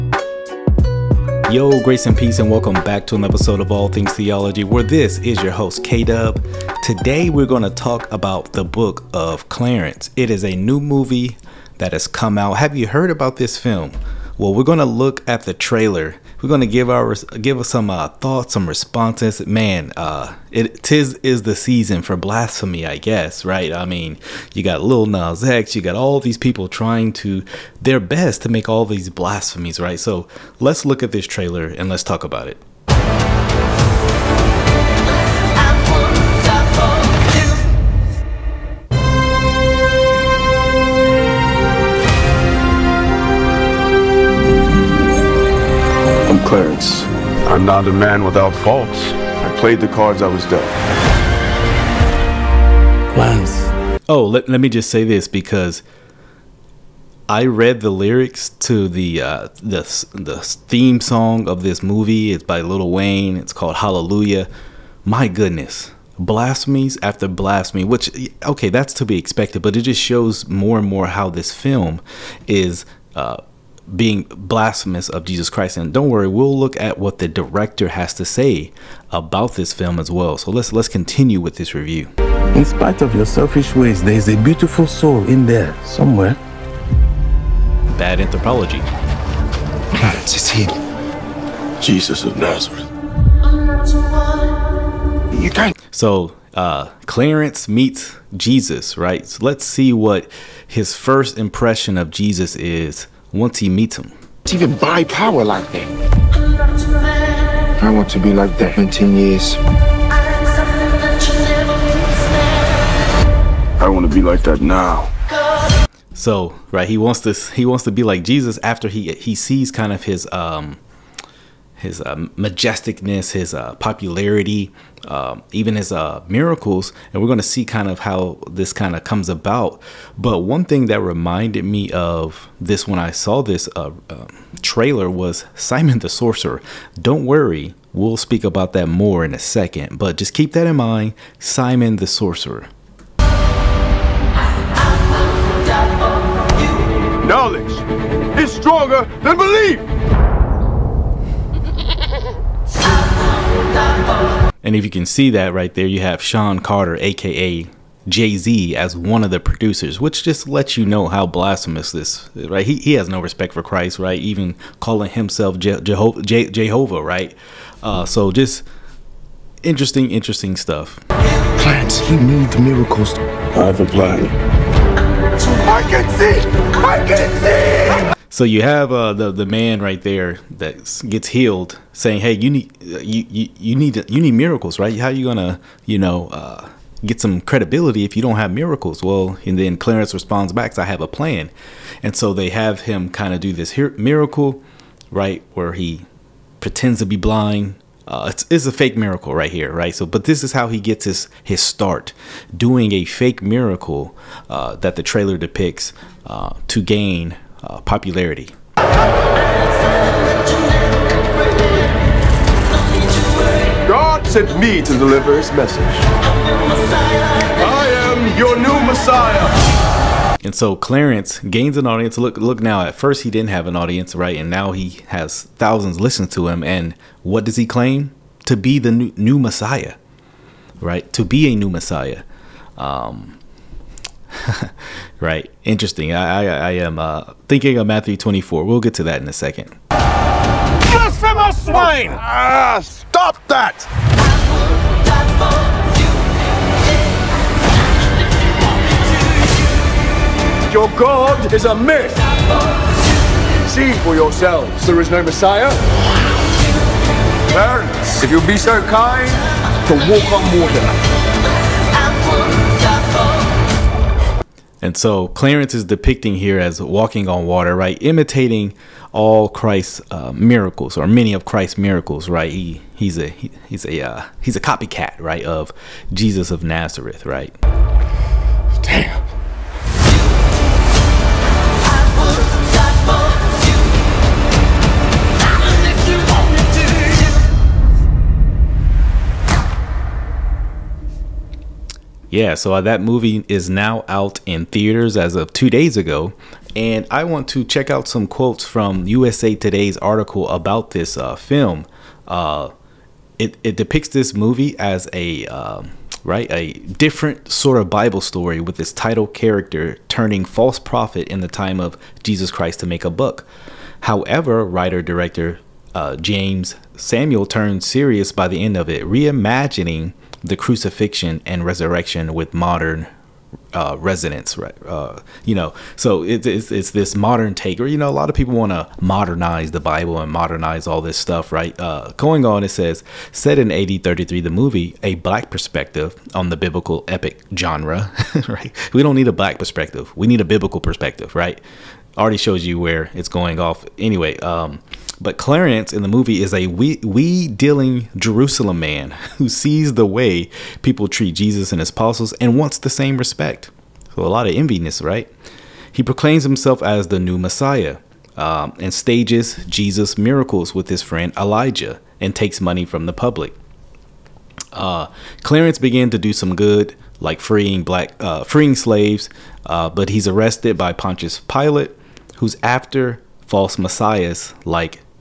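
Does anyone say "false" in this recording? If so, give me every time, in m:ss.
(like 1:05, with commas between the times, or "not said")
5:10, 6:13.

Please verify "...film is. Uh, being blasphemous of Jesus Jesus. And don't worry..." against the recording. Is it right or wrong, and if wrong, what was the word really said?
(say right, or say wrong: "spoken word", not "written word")
wrong: "Christ", not "Jesus".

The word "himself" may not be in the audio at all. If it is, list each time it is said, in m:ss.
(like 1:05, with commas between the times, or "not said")
2:45, 5:56.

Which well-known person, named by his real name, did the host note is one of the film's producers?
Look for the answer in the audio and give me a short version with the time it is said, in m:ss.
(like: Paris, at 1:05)
Sean Carter, at 2:36.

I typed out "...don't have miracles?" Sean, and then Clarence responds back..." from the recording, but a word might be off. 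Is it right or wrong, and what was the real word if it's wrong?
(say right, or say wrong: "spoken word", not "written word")
wrong: "Well", not "Sean".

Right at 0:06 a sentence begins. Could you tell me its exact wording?
Today, we're going to talk about the book of Clarence.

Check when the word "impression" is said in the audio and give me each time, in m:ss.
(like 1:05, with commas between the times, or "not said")
1:41.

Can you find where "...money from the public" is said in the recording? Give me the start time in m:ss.
6:02.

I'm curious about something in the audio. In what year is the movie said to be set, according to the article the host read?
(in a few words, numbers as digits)
AD 33.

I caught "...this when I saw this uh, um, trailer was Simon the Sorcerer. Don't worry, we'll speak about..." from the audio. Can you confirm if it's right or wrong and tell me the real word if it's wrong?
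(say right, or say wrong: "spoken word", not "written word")
right.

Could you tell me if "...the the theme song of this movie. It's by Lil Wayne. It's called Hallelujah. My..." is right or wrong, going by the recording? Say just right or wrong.
right.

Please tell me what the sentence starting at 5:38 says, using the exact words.
We don't need a black perspective, we need a biblical perspective, right?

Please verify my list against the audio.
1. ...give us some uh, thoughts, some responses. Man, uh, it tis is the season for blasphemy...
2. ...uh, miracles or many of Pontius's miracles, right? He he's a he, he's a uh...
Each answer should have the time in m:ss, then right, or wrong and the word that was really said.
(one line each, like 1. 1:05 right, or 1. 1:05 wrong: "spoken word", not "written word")
1. 0:17 right
2. 4:30 wrong: "Christ", not "Pontius".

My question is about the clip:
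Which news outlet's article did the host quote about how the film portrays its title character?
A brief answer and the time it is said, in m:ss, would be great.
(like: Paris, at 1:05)
USA Today, at 4:59.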